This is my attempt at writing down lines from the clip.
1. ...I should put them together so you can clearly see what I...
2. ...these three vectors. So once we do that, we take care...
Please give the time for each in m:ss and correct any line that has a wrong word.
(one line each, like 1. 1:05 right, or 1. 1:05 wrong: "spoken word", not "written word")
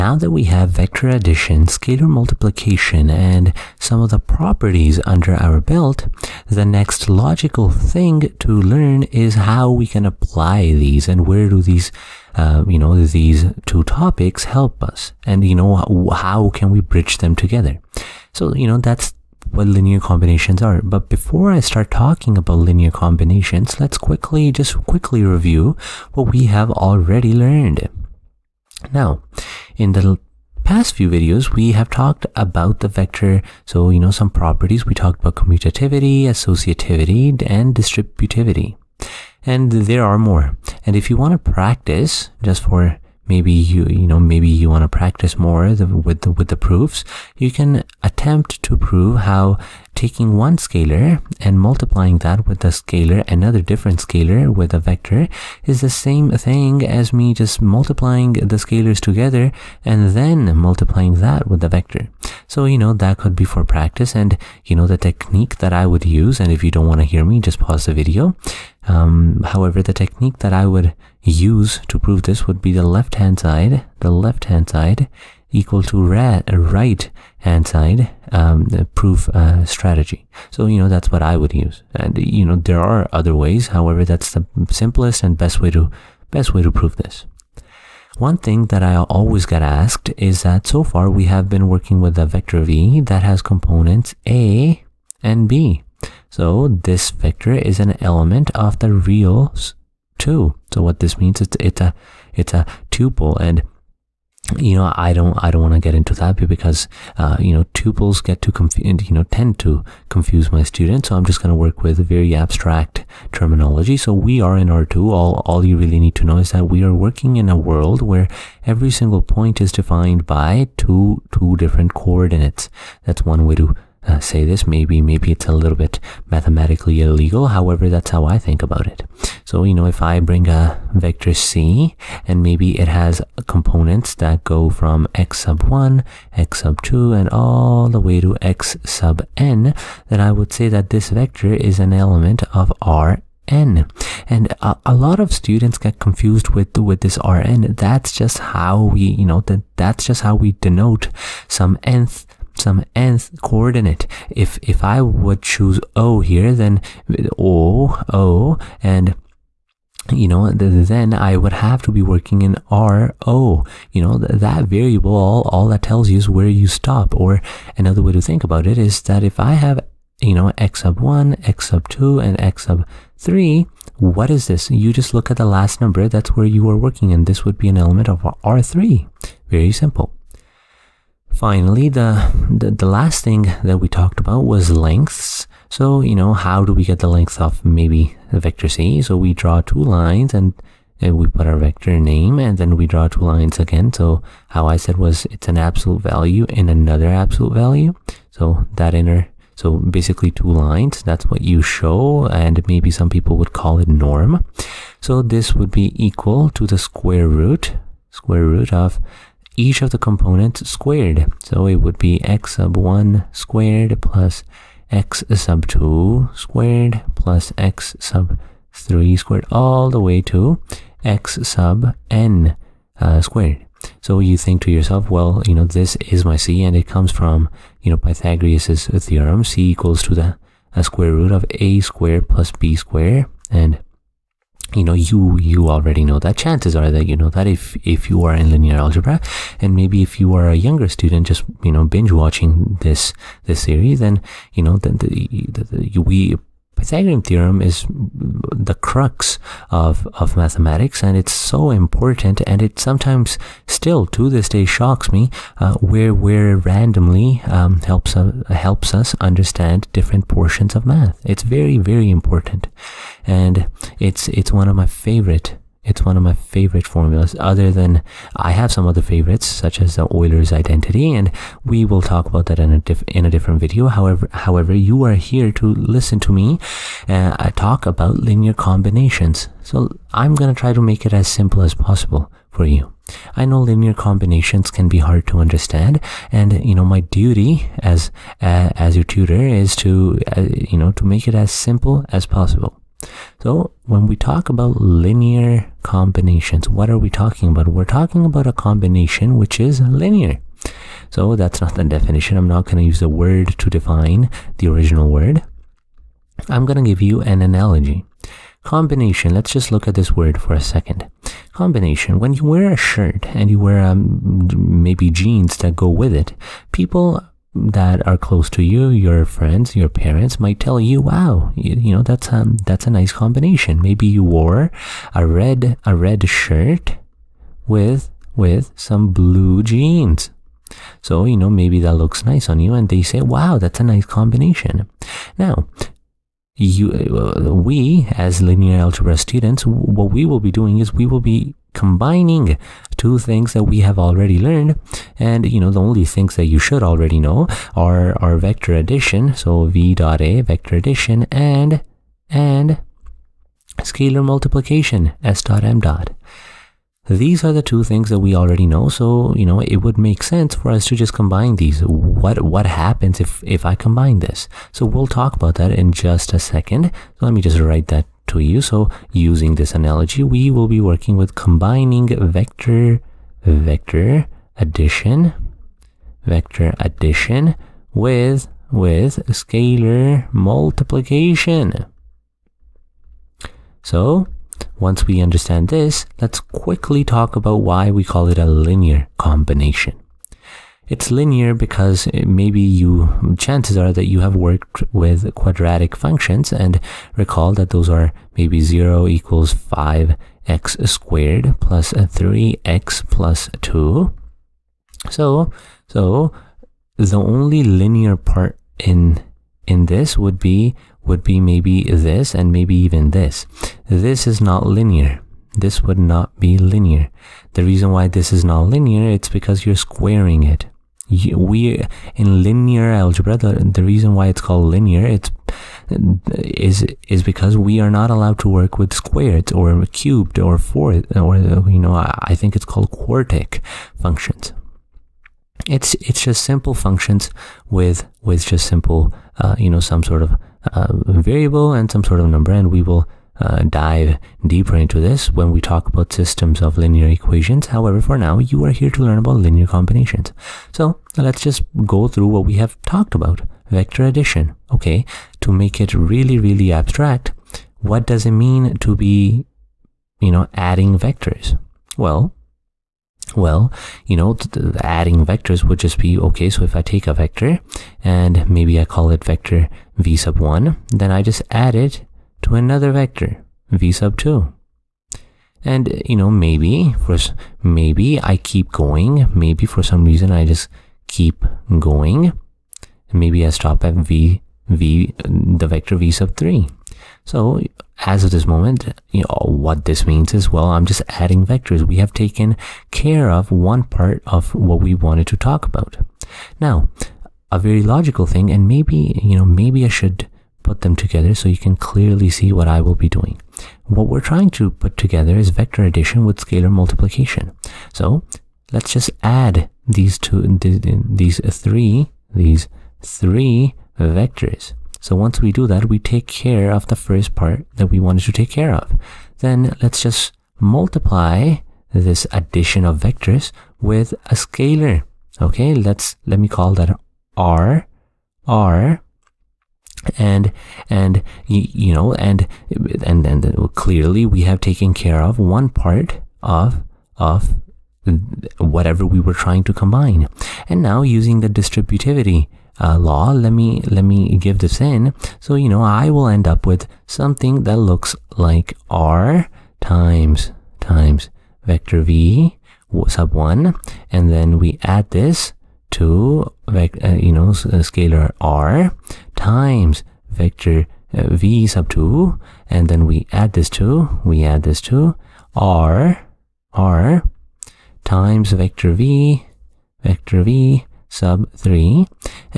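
1. 8:19 right
2. 8:32 right.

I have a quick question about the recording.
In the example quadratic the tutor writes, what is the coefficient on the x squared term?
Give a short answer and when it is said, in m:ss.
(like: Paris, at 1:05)
5, at 6:39.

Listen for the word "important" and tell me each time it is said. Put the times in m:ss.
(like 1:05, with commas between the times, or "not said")
4:11, 4:22.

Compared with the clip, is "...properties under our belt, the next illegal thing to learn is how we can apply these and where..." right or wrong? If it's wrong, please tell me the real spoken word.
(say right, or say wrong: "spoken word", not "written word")
wrong: "logical", not "illegal".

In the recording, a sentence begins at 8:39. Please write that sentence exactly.
Then let's just multiply this addition of vectors with a scalar.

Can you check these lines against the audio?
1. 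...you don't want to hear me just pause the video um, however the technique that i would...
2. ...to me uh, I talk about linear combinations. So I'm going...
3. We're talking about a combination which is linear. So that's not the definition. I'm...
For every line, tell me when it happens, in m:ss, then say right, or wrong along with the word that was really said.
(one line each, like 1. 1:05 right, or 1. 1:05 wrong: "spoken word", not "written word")
1. 1:06 right
2. 4:36 right
3. 4:57 right.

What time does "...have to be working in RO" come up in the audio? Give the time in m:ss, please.
2:41.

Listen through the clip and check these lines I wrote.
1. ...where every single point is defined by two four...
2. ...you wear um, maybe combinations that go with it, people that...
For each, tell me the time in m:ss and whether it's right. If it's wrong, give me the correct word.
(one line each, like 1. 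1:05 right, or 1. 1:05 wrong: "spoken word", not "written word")
1. 1:58 wrong: "two", not "four"
2. 5:13 wrong: "jeans", not "combinations".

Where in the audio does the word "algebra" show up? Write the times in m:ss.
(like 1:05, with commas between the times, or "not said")
3:58, 5:38, 7:02.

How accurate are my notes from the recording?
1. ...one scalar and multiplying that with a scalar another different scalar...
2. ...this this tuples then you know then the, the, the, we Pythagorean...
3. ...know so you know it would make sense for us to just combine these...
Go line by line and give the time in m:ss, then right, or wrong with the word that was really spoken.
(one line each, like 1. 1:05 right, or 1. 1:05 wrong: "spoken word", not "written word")
1. 0:50 right
2. 4:02 wrong: "series", not "tuples"
3. 5:58 right.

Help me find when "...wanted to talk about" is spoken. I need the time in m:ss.
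8:14.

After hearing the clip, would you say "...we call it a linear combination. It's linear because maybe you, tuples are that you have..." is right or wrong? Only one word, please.
wrong.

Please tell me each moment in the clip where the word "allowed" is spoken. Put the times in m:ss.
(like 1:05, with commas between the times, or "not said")
7:08.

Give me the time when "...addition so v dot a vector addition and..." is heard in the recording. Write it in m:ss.
5:48.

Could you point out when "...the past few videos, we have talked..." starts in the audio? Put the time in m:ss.
0:29.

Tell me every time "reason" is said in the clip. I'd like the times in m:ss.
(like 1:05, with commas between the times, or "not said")
6:57, 7:03, 8:00.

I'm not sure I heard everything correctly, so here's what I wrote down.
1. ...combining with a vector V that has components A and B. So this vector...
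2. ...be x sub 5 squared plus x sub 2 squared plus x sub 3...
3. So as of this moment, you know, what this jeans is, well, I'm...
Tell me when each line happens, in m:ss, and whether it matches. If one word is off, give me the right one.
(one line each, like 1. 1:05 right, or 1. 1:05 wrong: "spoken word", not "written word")
1. 1:31 wrong: "working", not "combining"
2. 3:31 wrong: "1", not "5"
3. 8:07 wrong: "means", not "jeans".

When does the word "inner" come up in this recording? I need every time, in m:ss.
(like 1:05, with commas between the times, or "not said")
3:18.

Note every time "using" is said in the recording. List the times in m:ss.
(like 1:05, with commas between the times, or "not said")
6:09, 9:01.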